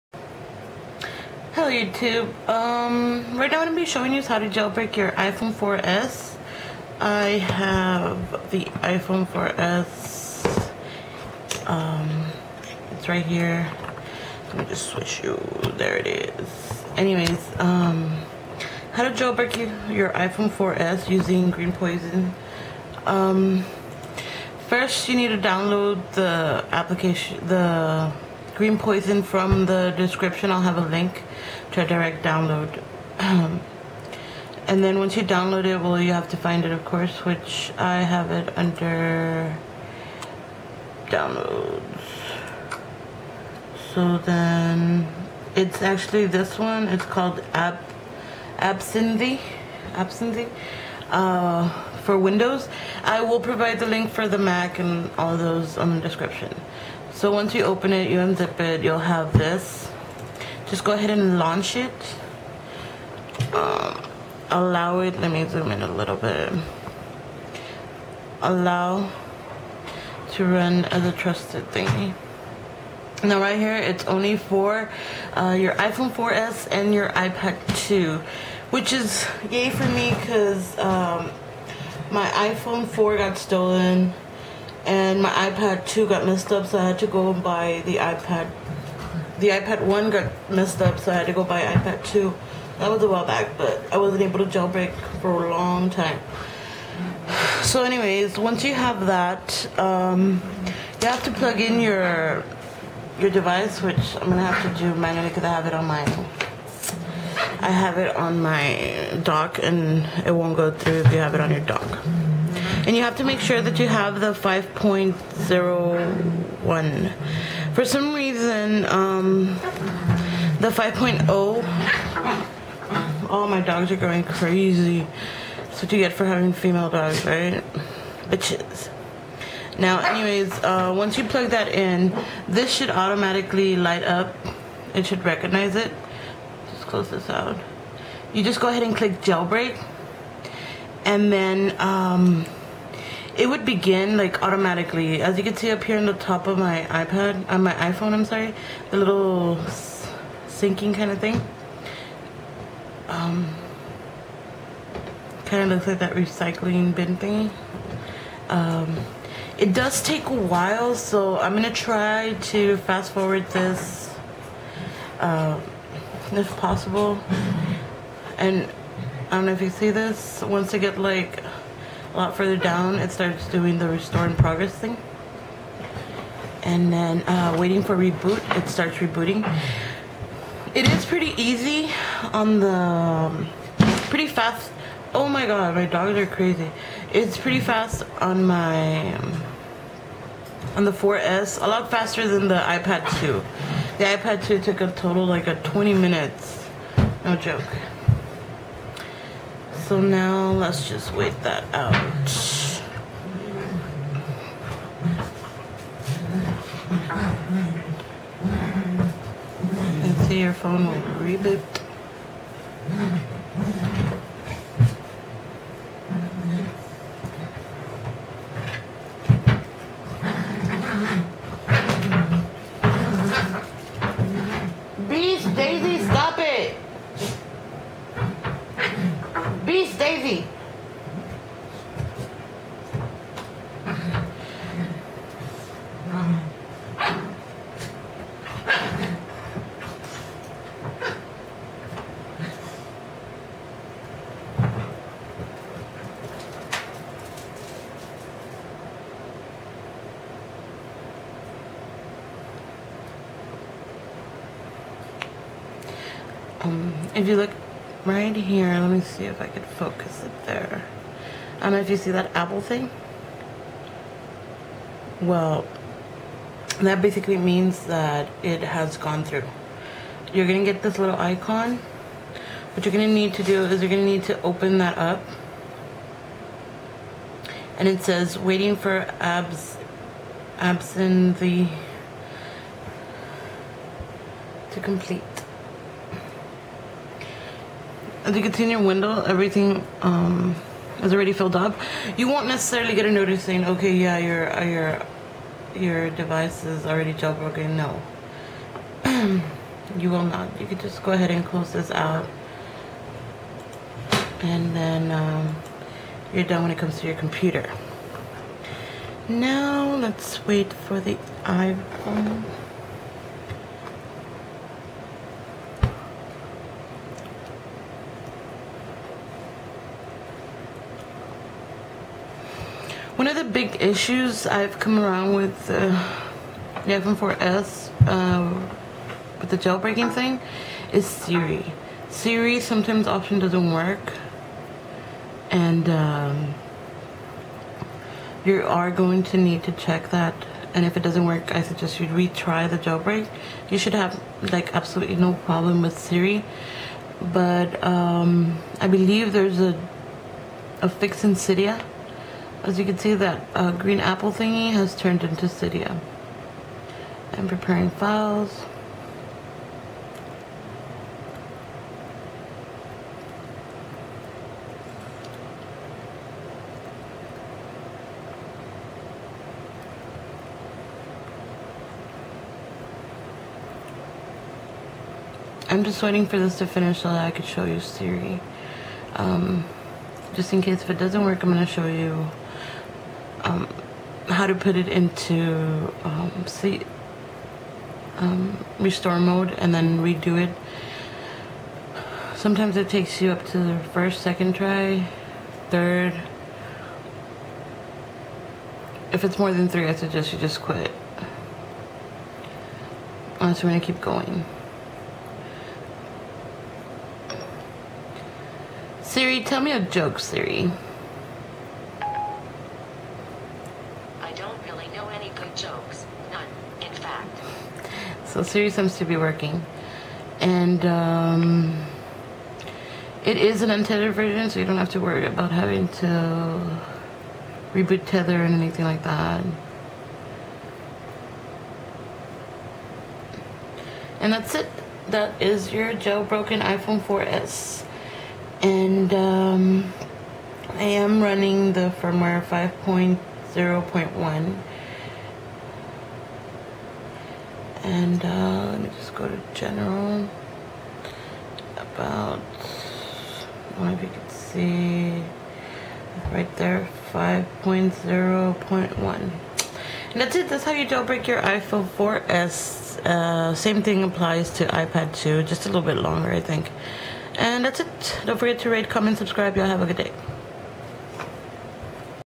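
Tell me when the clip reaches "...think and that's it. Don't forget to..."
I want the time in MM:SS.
07:46.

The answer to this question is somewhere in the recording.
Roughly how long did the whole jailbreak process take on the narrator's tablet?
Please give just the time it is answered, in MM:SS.
03:15.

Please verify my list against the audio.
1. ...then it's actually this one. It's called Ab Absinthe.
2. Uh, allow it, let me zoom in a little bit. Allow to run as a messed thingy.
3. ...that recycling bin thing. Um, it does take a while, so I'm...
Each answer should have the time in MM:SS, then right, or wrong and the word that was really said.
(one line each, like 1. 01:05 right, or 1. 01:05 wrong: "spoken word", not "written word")
1. 00:44 right
2. 01:03 wrong: "trusted", not "messed"
3. 02:35 right.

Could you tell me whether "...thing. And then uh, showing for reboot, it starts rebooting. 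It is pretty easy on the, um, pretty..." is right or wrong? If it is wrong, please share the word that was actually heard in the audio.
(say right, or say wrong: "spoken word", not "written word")
wrong: "waiting", not "showing".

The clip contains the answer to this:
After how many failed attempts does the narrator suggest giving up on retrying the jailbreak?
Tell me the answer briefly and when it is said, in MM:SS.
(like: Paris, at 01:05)
3, at 06:39.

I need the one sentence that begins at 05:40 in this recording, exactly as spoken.
And if it doesn't work, I suggest you retry the jailbreak.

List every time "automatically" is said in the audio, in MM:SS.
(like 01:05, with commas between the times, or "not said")
02:12, 02:24.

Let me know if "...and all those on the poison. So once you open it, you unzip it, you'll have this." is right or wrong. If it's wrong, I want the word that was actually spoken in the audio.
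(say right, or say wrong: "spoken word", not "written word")
wrong: "description", not "poison".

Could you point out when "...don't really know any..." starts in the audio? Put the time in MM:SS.
06:54.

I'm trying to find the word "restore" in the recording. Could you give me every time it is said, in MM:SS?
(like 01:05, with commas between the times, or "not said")
02:53, 06:28.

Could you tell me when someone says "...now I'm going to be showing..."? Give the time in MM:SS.
00:03.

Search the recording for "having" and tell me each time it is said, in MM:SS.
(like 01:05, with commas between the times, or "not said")
02:06, 07:05.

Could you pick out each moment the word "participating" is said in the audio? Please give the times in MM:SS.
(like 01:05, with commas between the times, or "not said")
not said.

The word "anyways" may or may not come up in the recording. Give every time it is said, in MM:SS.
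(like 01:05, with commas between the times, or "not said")
00:16, 01:37, 02:09.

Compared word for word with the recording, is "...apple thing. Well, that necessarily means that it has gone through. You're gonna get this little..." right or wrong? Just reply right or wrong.
wrong.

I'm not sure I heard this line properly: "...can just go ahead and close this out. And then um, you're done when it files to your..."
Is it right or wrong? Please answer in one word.
wrong.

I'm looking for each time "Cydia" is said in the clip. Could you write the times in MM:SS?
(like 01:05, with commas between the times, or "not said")
05:51, 05:55.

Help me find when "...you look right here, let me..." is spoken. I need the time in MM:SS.
04:17.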